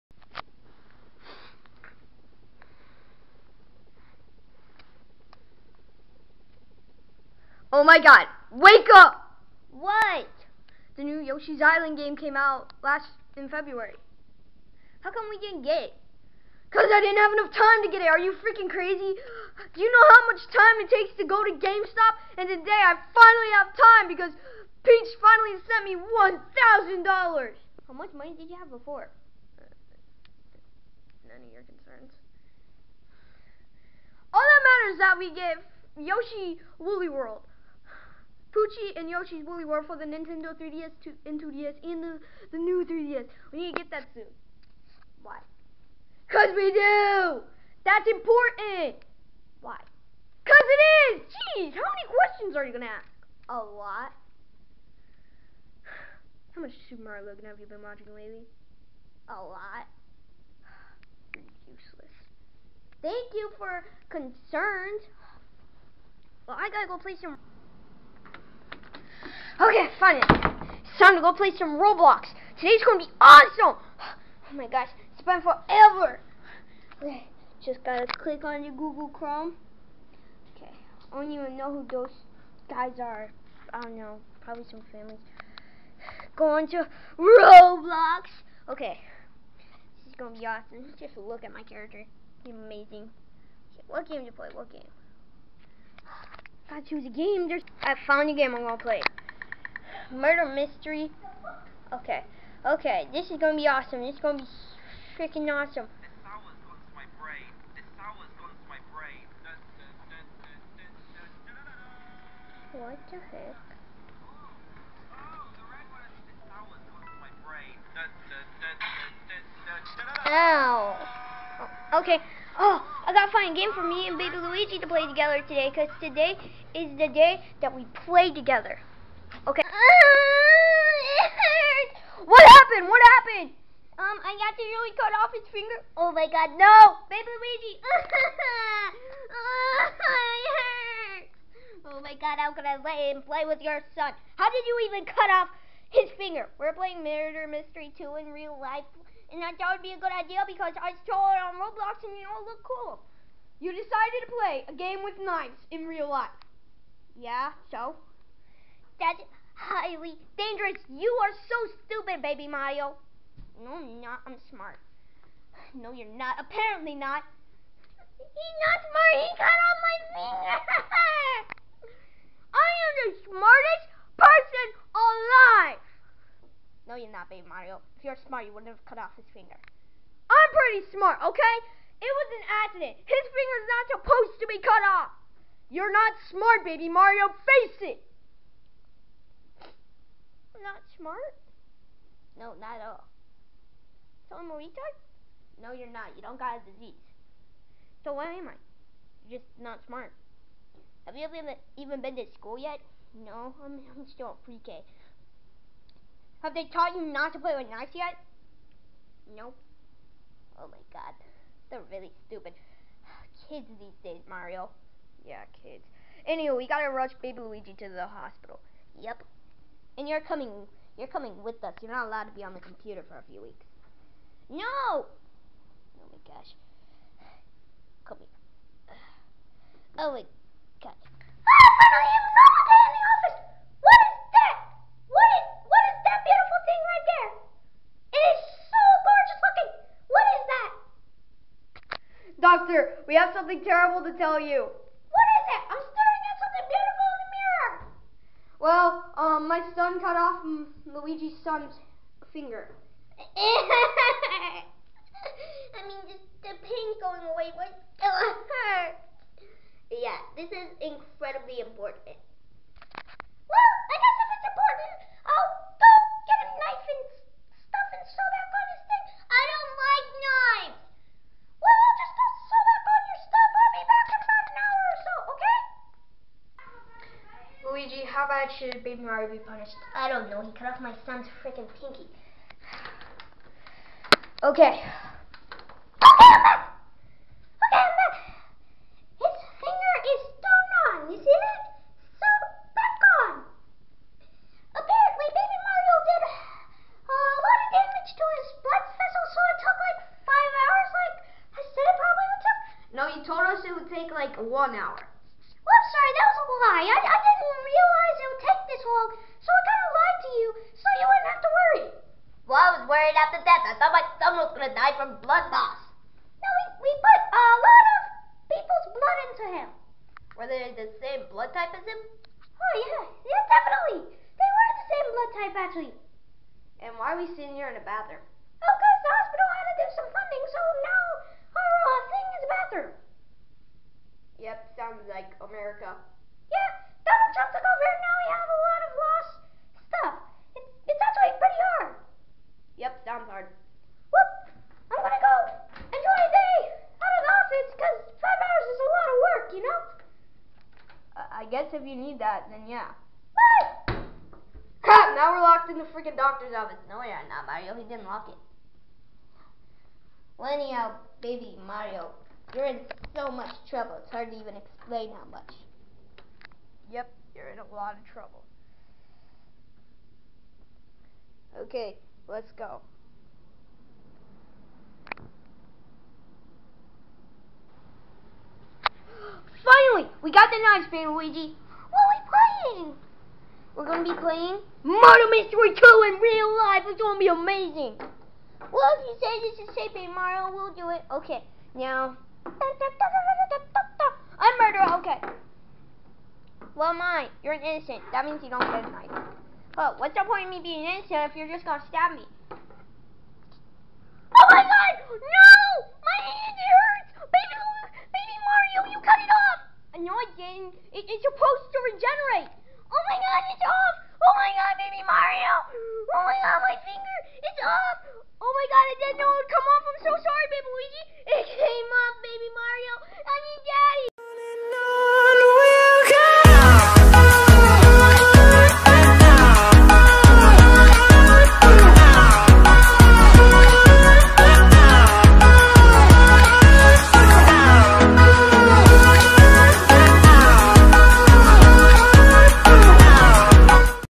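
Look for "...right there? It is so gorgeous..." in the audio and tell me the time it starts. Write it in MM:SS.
03:56.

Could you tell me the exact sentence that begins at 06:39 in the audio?
Oh, what's the point of me being innocent if you're just gonna stab me?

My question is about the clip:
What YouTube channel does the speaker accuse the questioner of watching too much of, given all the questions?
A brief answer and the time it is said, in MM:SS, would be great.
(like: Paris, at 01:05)
Super Mario Logan, at 00:56.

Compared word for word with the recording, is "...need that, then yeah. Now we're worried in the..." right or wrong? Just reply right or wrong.
wrong.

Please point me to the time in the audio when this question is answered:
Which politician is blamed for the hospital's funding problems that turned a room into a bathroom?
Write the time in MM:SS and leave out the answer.
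05:37.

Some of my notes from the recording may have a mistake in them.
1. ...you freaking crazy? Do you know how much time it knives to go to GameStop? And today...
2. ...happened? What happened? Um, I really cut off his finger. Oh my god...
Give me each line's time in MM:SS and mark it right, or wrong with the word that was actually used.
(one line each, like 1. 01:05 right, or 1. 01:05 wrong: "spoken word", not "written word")
1. 00:18 wrong: "takes", not "knives"
2. 02:12 right.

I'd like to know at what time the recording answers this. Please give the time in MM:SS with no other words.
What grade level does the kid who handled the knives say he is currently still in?
03:24.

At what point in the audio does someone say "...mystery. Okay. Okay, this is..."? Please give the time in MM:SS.
01:40.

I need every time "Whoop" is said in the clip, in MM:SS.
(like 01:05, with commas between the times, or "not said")
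05:44.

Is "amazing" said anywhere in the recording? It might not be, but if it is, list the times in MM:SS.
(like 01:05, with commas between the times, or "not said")
01:32, 06:27.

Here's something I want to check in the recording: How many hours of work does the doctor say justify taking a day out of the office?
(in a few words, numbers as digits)
5.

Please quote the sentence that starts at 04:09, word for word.
son cut off Luigi's son's finger.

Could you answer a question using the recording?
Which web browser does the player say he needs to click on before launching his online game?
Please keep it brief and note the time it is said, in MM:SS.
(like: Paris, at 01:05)
Google Chrome, at 01:18.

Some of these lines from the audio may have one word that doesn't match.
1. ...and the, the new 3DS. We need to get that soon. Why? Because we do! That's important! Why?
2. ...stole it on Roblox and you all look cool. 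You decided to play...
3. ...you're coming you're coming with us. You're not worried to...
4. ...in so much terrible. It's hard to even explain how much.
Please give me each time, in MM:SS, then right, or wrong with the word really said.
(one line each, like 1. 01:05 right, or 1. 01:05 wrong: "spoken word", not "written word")
1. 00:41 right
2. 02:31 right
3. 03:40 wrong: "allowed", not "worried"
4. 06:02 wrong: "trouble", not "terrible".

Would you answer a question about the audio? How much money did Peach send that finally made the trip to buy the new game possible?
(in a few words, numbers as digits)
$1,000.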